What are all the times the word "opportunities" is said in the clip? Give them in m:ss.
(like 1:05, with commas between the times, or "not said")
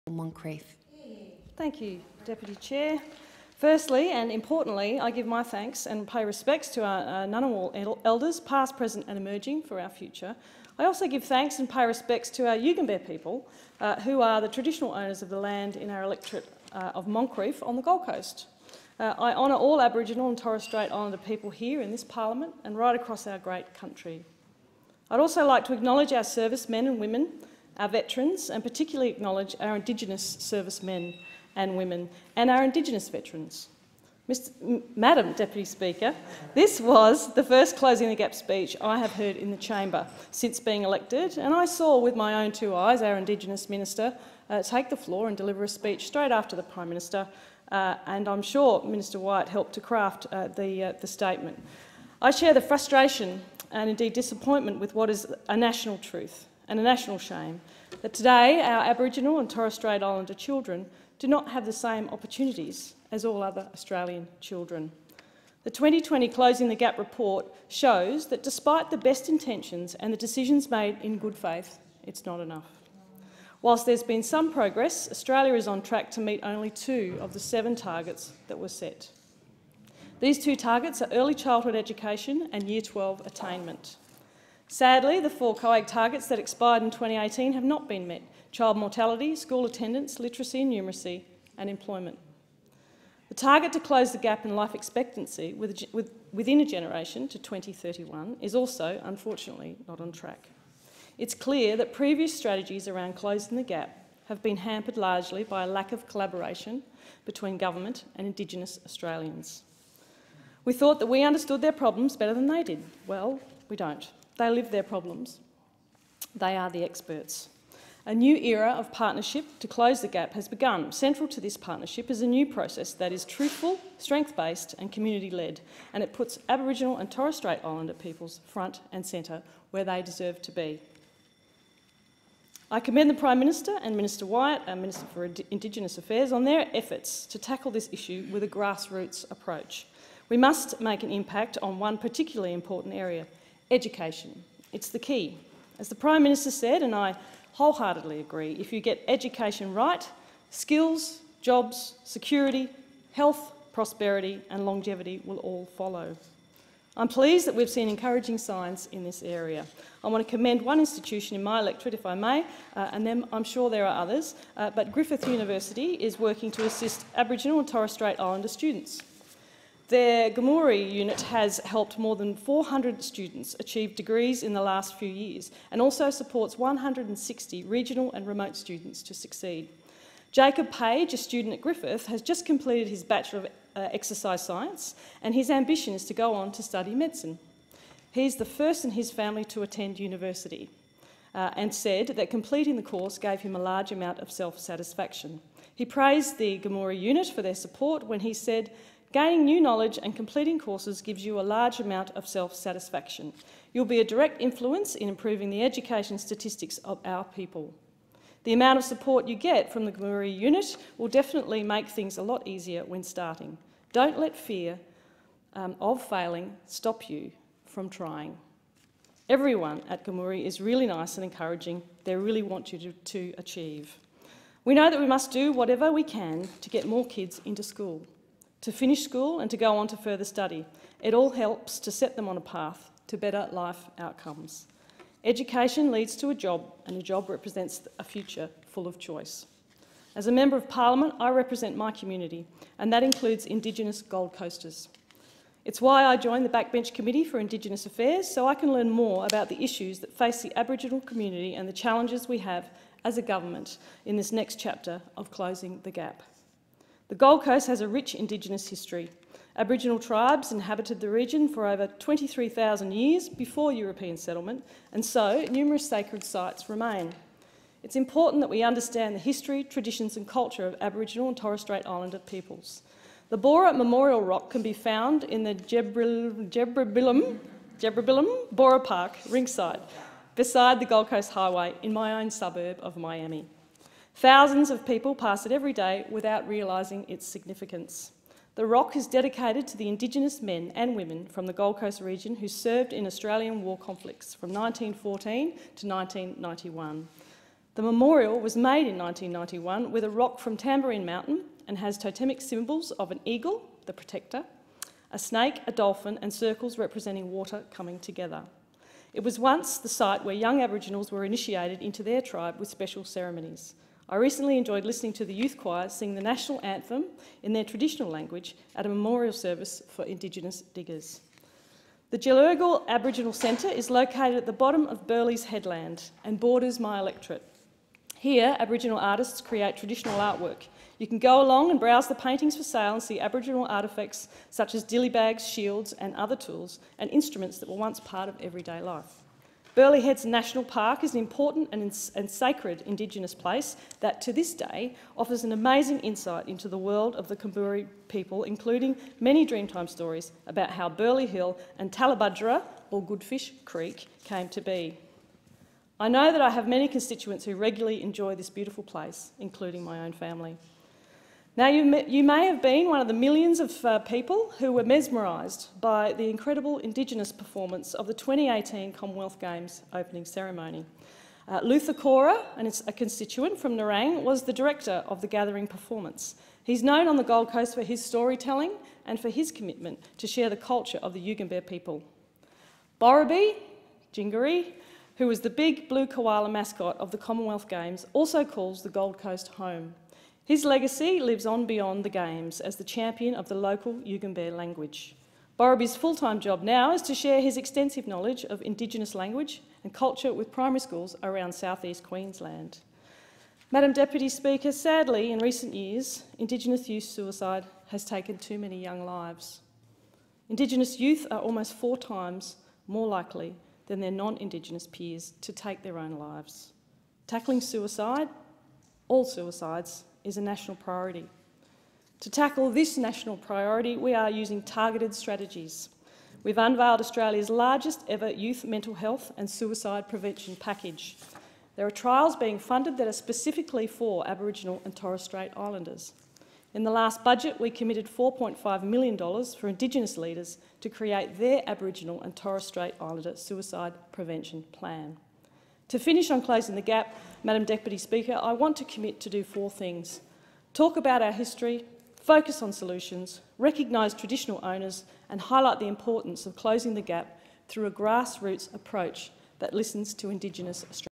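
1:02.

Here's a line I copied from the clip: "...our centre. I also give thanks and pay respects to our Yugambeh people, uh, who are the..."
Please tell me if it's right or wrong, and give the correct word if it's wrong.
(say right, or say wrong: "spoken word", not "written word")
wrong: "future", not "centre".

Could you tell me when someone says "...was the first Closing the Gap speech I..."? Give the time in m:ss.
0:36.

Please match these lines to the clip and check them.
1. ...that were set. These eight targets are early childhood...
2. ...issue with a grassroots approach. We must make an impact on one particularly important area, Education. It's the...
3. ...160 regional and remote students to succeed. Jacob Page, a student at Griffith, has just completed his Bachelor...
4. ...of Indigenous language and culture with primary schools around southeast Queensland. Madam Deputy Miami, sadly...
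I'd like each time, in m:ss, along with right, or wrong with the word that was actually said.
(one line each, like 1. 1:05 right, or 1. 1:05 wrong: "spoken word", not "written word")
1. 1:18 wrong: "two", not "eight"
2. 2:17 right
3. 2:56 right
4. 6:38 wrong: "Speaker", not "Miami".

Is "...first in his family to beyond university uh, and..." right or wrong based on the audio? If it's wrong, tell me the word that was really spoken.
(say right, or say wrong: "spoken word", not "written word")
wrong: "attend", not "beyond".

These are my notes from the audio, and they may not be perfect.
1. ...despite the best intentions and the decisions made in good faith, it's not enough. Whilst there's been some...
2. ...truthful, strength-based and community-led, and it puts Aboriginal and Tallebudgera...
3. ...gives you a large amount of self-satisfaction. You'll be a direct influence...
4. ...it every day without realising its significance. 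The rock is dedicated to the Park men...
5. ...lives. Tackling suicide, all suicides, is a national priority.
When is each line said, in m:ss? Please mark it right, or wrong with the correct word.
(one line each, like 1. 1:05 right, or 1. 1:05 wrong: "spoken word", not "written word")
1. 1:08 right
2. 2:03 wrong: "Torres", not "Tallebudgera"
3. 3:21 right
4. 4:45 wrong: "Indigenous", not "Park"
5. 6:56 right.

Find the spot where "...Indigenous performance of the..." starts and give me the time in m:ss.
6:06.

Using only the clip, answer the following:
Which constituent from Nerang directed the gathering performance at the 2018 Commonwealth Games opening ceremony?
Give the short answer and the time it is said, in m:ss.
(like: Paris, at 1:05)
Luther Cora, at 6:11.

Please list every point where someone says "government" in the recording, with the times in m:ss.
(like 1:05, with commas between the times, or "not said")
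1:47, 4:13.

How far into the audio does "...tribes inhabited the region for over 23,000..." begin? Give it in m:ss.
4:19.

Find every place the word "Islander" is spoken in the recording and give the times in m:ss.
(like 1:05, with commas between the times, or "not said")
0:20, 1:00, 2:07, 2:48, 4:31, 7:15, 7:23.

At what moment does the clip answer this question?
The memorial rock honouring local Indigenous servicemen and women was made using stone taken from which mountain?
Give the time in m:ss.
5:00.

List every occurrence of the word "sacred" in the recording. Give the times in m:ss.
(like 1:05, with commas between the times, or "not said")
4:25, 5:42.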